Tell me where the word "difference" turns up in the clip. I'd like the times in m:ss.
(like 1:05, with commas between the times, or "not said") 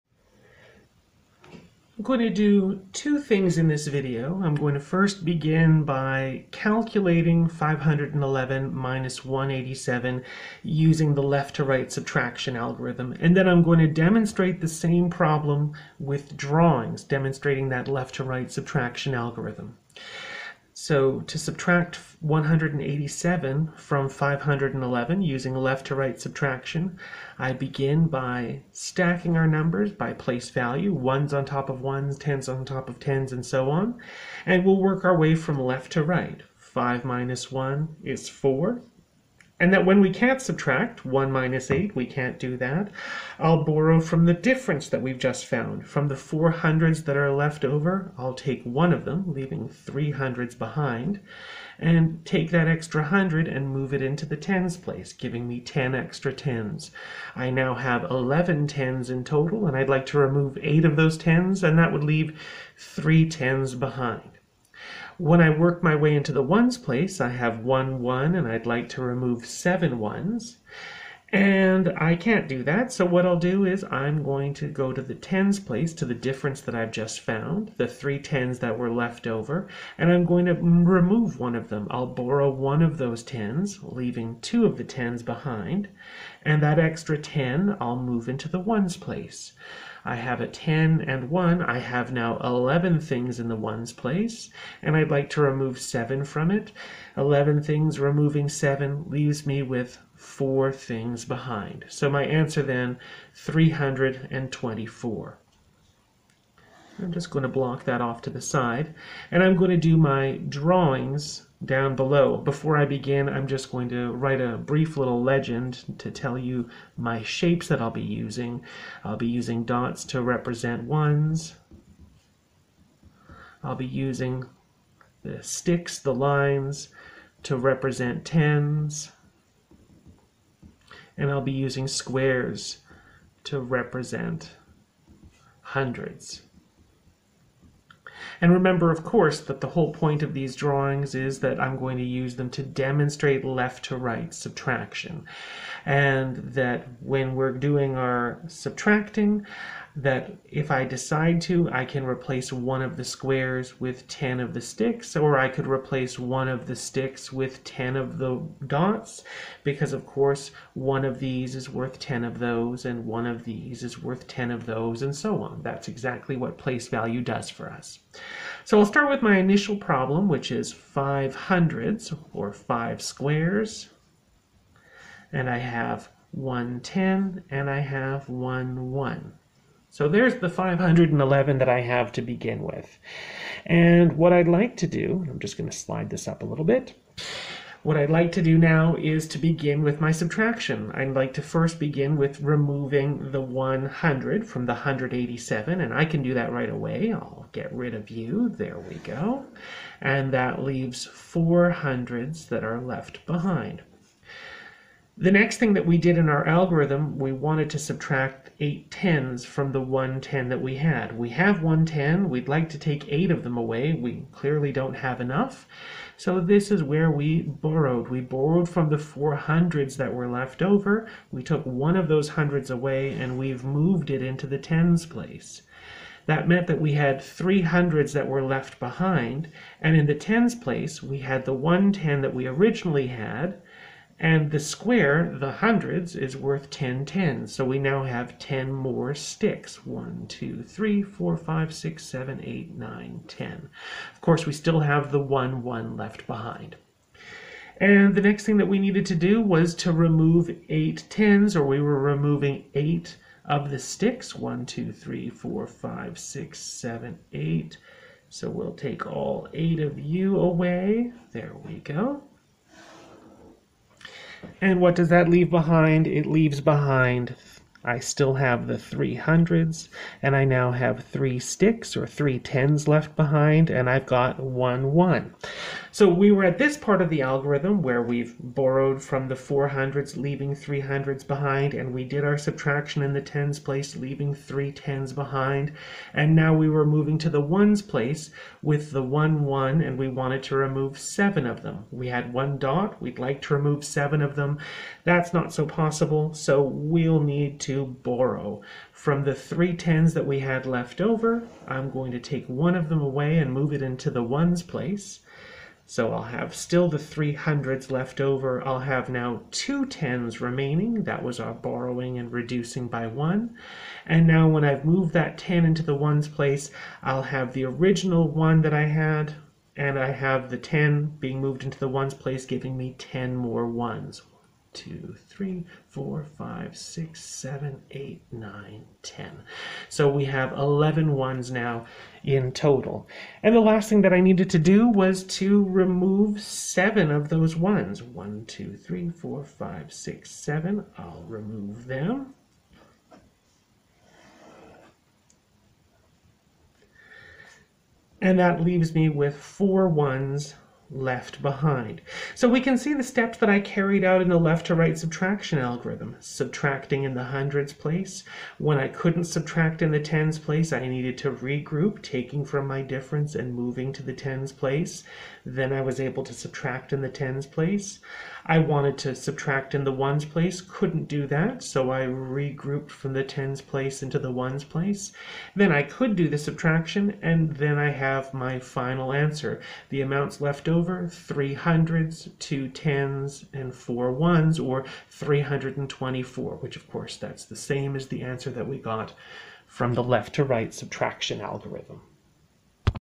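0:44, 1:16, 6:02.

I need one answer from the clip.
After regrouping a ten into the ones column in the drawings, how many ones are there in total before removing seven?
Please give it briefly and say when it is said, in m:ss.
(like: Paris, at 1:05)
11, at 5:30.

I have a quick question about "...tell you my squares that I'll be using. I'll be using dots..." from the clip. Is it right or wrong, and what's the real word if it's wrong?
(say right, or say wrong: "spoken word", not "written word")
wrong: "shapes", not "squares".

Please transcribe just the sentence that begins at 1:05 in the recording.
When I work my way into the ones place, I have one one and I'd like to remove seven ones.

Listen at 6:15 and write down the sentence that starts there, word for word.
Then I could do the subtraction, and then I have my final answer.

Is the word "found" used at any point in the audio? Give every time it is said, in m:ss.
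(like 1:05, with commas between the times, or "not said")
0:45, 1:17.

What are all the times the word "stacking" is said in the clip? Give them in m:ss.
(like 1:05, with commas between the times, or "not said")
0:28.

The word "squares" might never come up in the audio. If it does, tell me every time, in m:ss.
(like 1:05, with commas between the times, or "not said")
2:11, 2:33, 2:53, 3:54.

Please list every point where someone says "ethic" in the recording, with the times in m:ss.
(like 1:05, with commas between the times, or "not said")
not said.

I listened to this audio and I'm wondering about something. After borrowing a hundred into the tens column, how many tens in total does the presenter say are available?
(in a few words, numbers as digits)
11.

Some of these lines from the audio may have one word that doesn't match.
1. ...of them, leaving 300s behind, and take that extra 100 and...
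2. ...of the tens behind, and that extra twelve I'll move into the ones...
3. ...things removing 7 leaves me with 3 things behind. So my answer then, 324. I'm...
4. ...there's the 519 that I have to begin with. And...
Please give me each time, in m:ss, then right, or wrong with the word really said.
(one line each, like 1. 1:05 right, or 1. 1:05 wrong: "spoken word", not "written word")
1. 0:48 right
2. 1:24 wrong: "ten", not "twelve"
3. 1:37 wrong: "4", not "3"
4. 3:00 wrong: "511", not "519".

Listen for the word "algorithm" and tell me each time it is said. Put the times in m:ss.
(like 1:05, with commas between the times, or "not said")
0:12, 0:19, 3:26, 4:37, 5:55, 6:31.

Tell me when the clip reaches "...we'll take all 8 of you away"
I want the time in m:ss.
4:18.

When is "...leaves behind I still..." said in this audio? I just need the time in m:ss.
4:26.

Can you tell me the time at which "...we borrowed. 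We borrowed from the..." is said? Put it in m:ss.
3:37.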